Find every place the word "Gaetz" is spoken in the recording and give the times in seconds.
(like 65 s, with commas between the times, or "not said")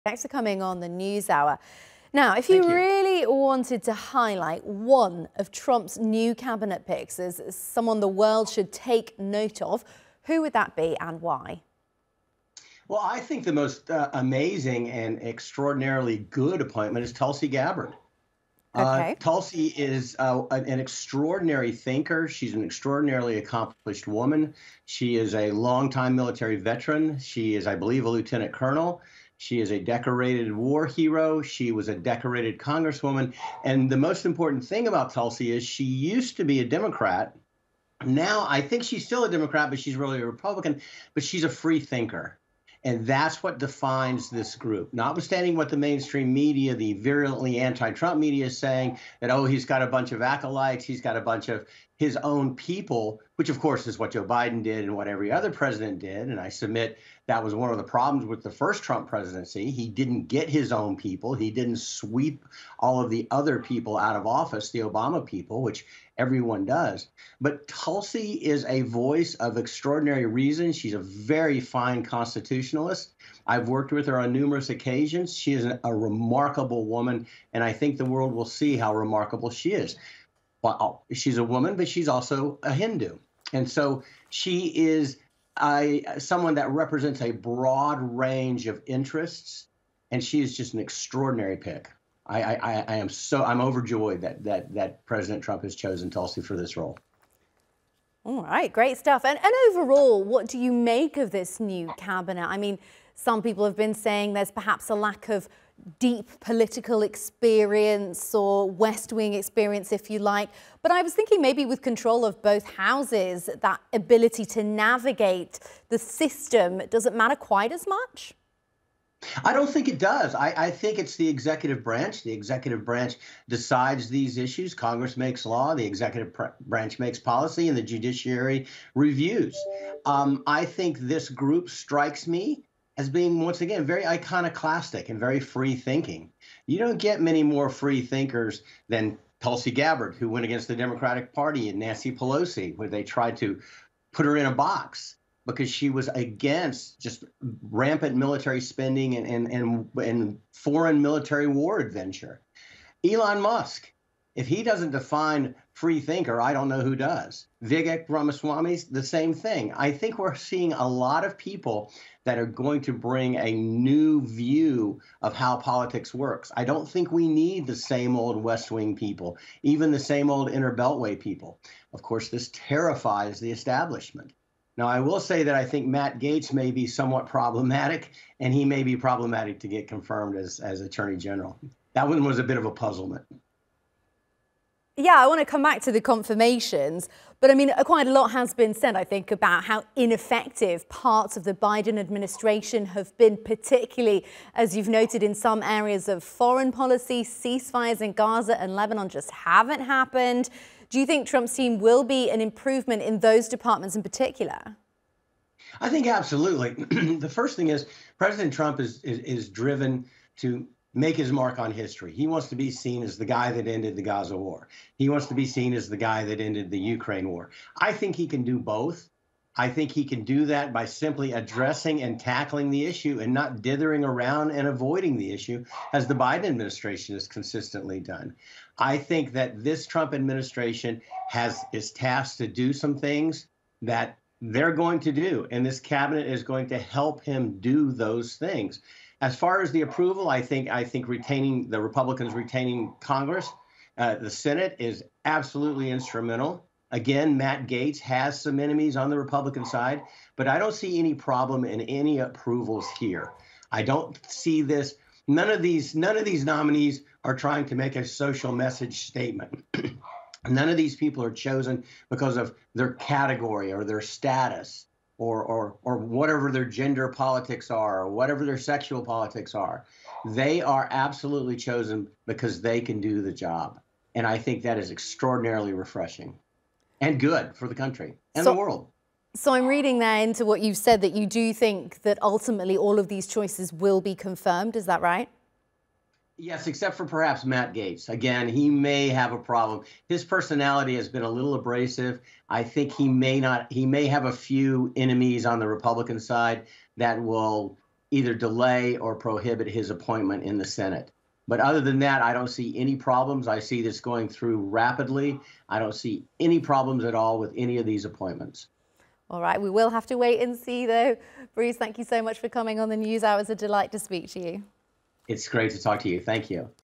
176 s, 287 s.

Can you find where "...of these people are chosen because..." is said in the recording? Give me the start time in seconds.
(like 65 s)
260 s.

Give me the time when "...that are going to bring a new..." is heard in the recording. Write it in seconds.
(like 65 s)
162 s.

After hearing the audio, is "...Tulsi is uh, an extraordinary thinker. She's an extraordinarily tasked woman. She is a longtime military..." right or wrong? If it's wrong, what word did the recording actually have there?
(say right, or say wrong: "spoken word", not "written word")
wrong: "accomplished", not "tasked".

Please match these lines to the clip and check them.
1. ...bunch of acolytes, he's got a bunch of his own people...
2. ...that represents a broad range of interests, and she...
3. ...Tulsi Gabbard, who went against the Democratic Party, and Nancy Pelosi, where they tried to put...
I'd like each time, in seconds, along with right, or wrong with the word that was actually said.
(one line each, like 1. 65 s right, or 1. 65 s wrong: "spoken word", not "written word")
1. 49 s right
2. 86 s right
3. 139 s right.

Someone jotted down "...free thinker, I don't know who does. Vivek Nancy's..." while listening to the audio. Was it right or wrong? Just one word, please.
wrong.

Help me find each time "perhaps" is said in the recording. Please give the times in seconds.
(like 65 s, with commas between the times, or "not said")
104 s, 287 s.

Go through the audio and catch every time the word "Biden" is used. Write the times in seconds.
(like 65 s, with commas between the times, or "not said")
54 s, 191 s, 226 s.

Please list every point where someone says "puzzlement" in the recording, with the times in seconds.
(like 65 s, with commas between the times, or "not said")
182 s.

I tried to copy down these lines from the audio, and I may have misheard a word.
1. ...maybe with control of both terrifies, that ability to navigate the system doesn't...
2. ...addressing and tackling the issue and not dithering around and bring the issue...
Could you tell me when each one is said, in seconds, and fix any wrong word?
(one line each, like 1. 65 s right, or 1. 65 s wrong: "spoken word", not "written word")
1. 111 s wrong: "houses", not "terrifies"
2. 221 s wrong: "avoiding", not "bring".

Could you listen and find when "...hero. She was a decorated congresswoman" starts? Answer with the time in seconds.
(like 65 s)
30 s.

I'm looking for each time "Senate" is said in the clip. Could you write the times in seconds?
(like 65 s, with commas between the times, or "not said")
244 s, 300 s.